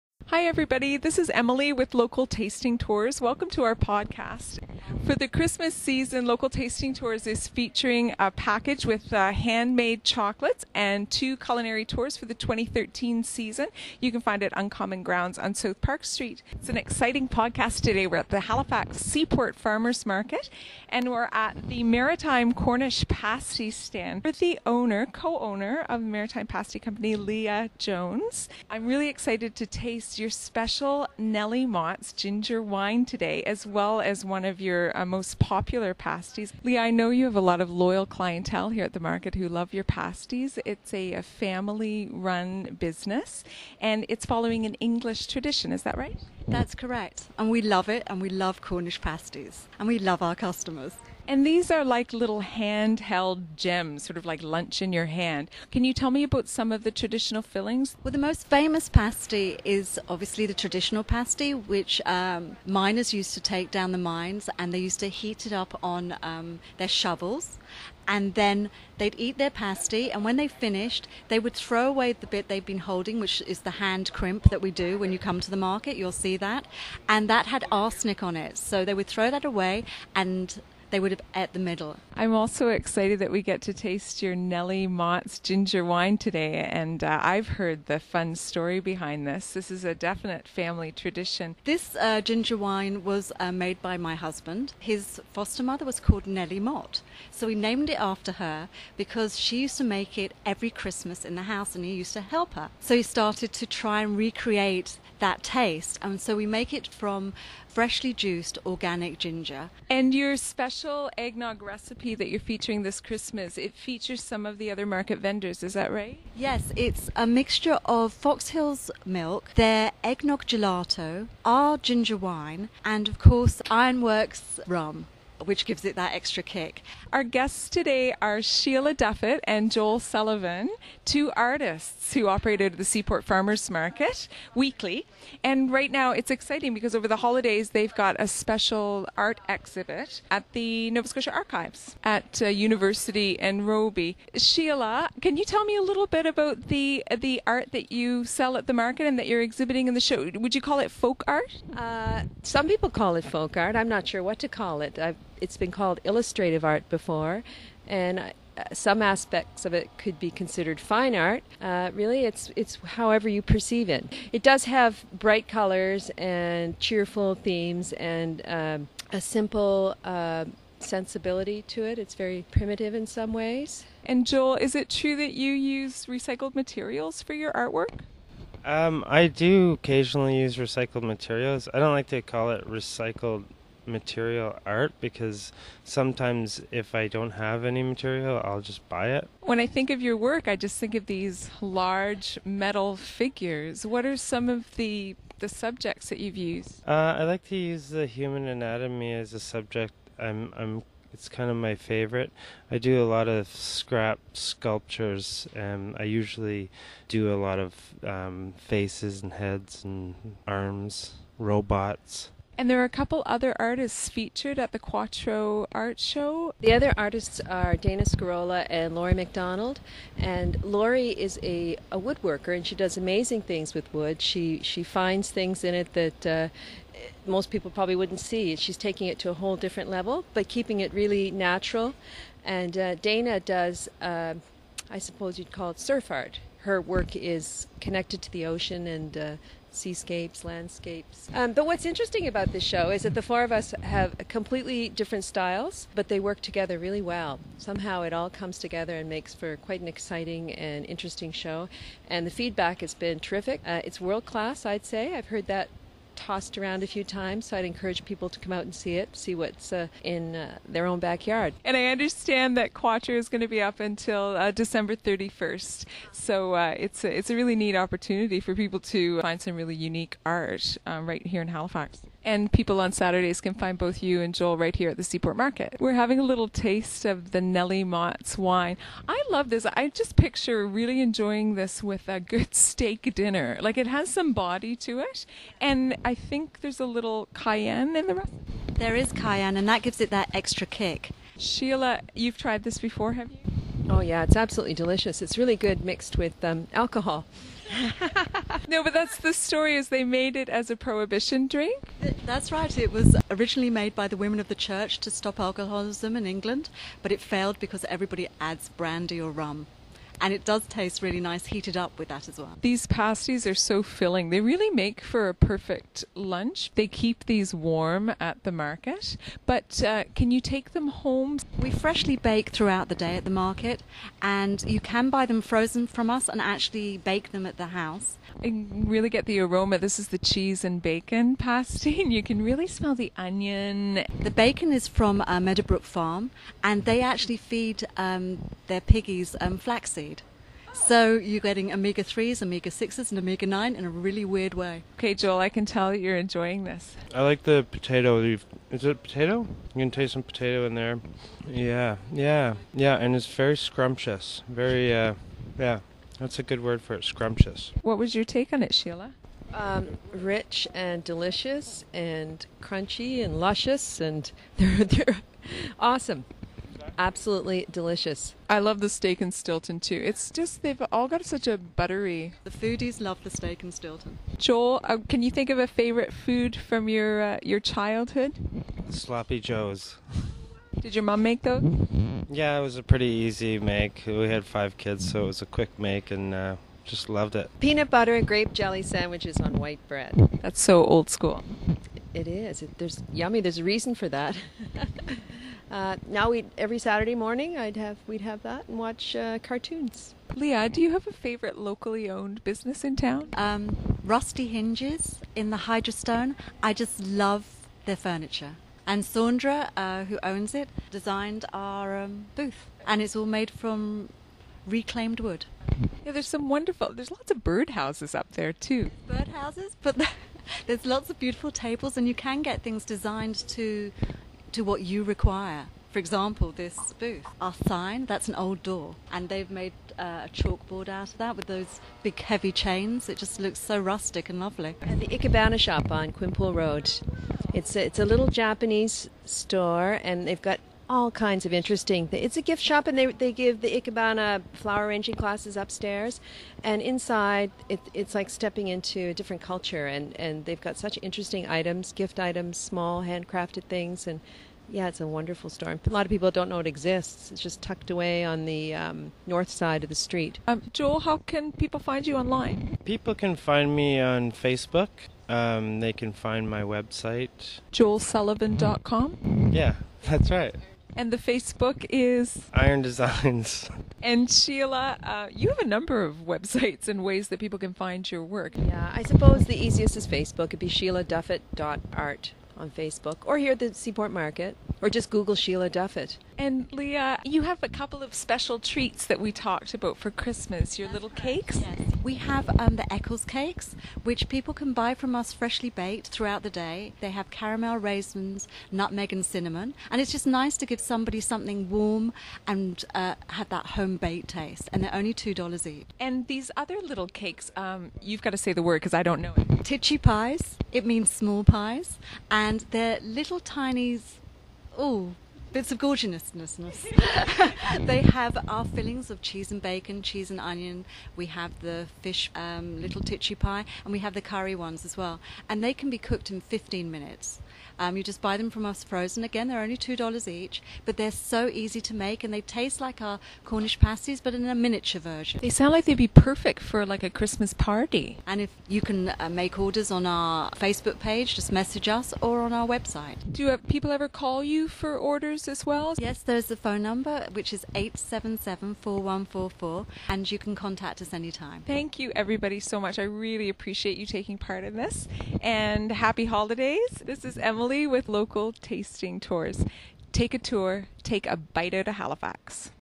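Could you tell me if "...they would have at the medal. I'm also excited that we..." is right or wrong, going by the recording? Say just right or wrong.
right.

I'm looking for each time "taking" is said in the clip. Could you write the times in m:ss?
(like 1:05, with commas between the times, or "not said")
3:48, 9:14.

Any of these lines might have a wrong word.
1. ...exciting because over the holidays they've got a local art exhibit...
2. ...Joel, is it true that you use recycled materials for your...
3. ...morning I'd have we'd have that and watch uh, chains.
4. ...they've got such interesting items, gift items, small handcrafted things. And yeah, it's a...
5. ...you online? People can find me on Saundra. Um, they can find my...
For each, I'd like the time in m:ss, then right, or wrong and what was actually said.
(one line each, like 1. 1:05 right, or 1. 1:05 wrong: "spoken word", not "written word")
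1. 2:16 wrong: "special", not "local"
2. 2:54 right
3. 6:37 wrong: "cartoons", not "chains"
4. 7:30 right
5. 7:42 wrong: "Facebook", not "Saundra".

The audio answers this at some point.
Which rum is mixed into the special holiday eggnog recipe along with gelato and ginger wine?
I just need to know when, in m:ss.
2:03.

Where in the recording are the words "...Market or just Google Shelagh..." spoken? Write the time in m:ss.
8:04.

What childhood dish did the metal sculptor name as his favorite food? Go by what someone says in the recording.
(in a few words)
Sloppy joes.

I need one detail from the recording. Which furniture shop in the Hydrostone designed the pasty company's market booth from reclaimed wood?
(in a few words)
Rusty Hinges.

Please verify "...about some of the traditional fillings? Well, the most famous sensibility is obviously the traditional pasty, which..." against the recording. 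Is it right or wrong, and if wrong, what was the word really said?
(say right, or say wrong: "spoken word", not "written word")
wrong: "pasty", not "sensibility".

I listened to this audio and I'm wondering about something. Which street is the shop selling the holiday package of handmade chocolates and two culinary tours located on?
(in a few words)
South Park Street.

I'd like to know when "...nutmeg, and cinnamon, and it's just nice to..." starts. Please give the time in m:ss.
8:18.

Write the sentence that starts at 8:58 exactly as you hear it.
And if you can uh, make orders on our Facebook page, just message us or on our website.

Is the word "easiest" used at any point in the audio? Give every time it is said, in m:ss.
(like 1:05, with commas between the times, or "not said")
7:59.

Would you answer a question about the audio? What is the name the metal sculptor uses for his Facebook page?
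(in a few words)
Iron Designs.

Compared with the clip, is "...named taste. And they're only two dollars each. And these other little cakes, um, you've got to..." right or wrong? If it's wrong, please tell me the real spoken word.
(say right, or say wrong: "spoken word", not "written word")
wrong: "baked", not "named".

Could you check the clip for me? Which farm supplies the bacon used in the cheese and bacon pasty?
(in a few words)
Meadowbrook Farm.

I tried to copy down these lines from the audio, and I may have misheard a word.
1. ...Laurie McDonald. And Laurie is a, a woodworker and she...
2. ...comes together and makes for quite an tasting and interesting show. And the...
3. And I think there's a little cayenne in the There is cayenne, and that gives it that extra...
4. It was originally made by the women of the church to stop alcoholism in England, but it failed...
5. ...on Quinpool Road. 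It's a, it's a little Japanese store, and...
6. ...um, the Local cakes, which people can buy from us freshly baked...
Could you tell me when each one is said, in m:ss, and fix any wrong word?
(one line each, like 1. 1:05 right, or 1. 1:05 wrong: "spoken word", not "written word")
1. 3:38 right
2. 4:08 wrong: "exciting", not "tasting"
3. 4:45 right
4. 5:02 right
5. 7:15 right
6. 8:12 wrong: "Eccles", not "Local".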